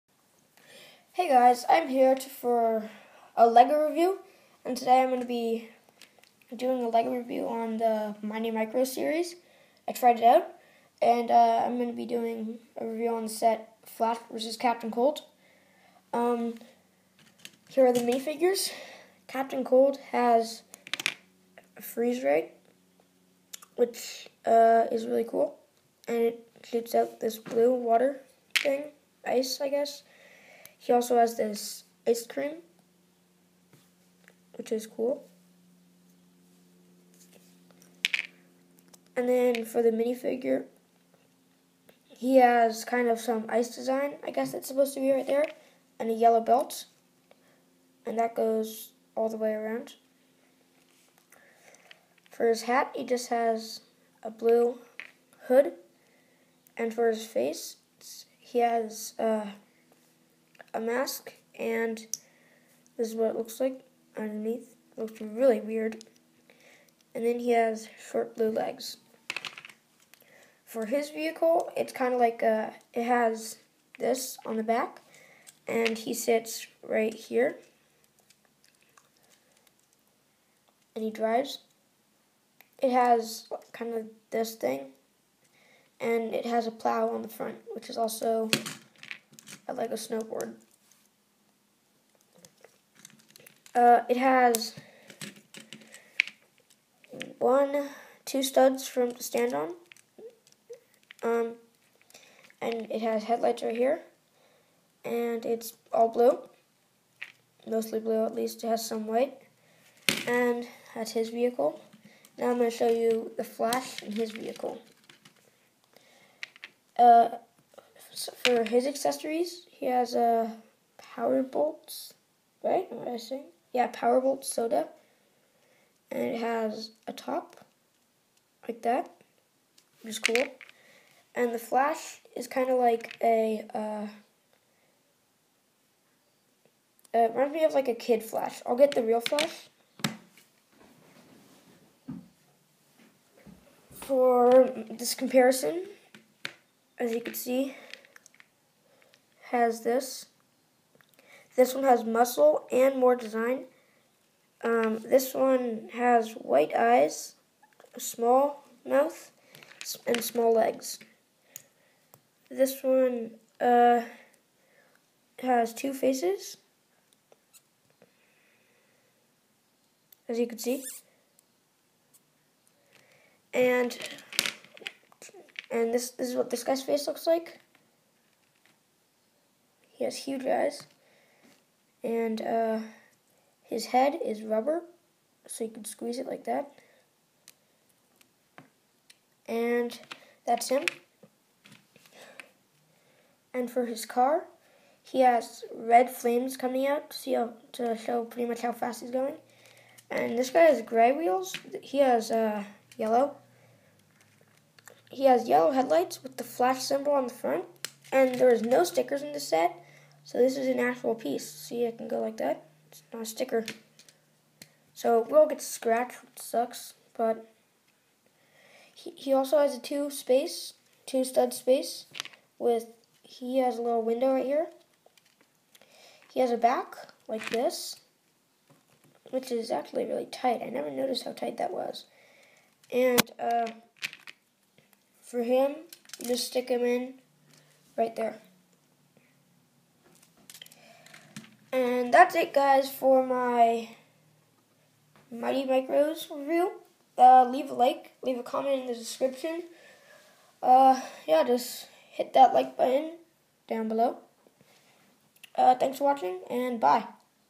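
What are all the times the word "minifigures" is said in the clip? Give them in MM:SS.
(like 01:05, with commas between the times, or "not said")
00:17, 00:39.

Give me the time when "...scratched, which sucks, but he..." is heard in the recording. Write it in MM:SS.
03:35.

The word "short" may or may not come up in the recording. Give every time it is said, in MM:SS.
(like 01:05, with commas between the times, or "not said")
01:08.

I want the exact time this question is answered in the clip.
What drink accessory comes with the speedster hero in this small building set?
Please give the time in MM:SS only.
02:03.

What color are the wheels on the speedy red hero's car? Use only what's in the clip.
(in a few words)
Gray.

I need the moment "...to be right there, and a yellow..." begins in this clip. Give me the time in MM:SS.
00:44.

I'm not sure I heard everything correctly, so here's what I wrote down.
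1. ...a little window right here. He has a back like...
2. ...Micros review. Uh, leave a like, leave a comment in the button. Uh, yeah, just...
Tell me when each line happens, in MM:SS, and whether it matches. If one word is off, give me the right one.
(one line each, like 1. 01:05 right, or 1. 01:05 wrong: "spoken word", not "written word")
1. 03:43 right
2. 04:05 wrong: "description", not "button".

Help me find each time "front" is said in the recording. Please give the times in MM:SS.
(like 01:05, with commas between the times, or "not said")
01:27, 03:27.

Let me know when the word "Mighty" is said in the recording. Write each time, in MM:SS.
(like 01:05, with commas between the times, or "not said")
00:08, 04:05.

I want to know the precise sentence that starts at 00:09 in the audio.
I tried it out, and uh, I'm going to be doing a review on the set Flash versus Captain Cold.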